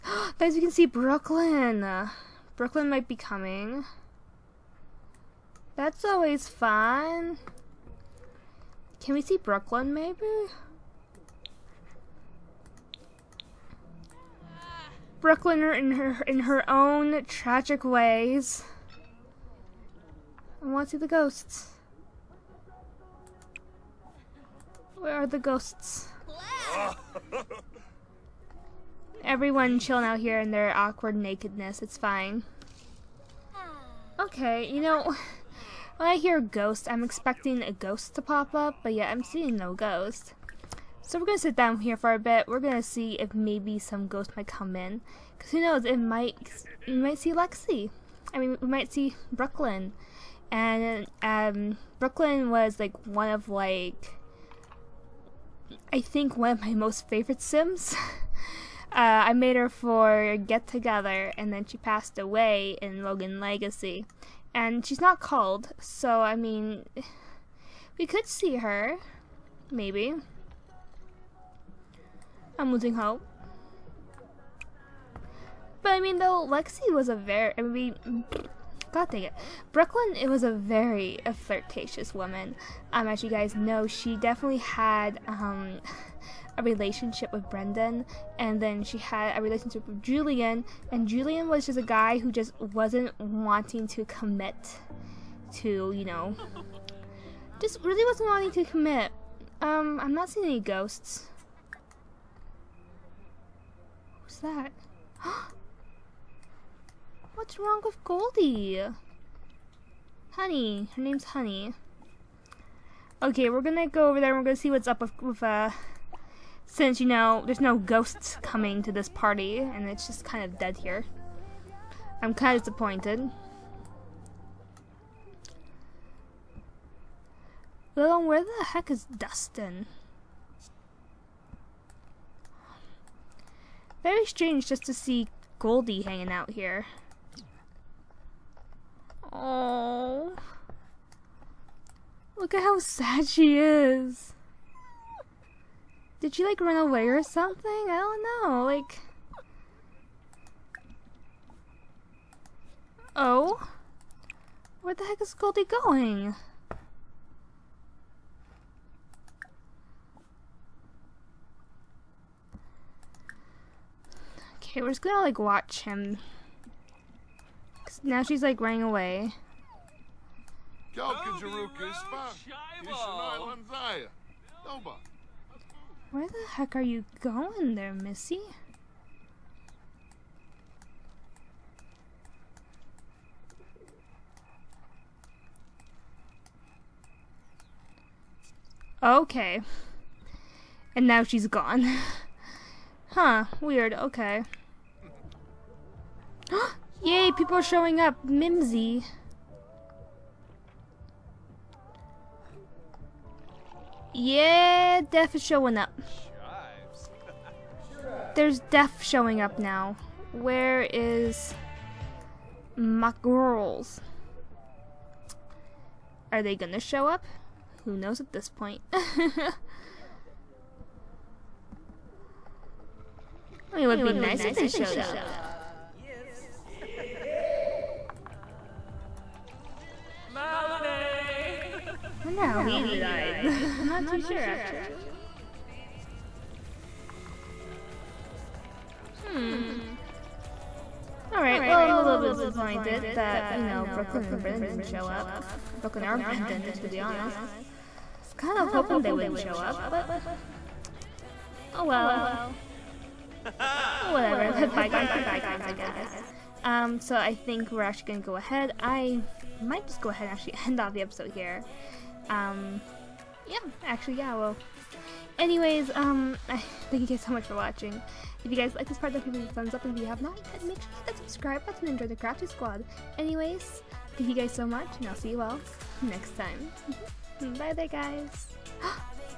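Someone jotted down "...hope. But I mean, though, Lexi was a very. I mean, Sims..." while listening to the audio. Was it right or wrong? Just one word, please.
wrong.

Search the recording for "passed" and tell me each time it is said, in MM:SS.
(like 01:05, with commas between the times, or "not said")
01:01.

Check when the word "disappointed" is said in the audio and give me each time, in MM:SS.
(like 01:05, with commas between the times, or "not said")
02:02, 04:02.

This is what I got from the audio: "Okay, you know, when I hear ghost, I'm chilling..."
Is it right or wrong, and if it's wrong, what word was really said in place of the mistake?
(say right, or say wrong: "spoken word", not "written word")
wrong: "expecting", not "chilling".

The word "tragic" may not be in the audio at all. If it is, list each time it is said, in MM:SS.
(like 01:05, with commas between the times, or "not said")
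00:17.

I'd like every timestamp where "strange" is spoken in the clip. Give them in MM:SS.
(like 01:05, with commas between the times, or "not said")
02:14.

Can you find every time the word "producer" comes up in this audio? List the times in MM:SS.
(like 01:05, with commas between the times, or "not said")
not said.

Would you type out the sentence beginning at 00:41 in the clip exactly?
So we're gonna sit down here for a bit.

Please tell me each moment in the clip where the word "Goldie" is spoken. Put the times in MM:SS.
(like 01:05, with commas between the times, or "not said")
01:48, 02:15, 02:35.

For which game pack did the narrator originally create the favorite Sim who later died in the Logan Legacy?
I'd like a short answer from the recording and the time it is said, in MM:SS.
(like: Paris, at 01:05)
Get Together, at 01:00.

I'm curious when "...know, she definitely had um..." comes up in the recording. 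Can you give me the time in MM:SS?
01:23.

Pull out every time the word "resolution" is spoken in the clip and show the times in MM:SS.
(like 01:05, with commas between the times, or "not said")
not said.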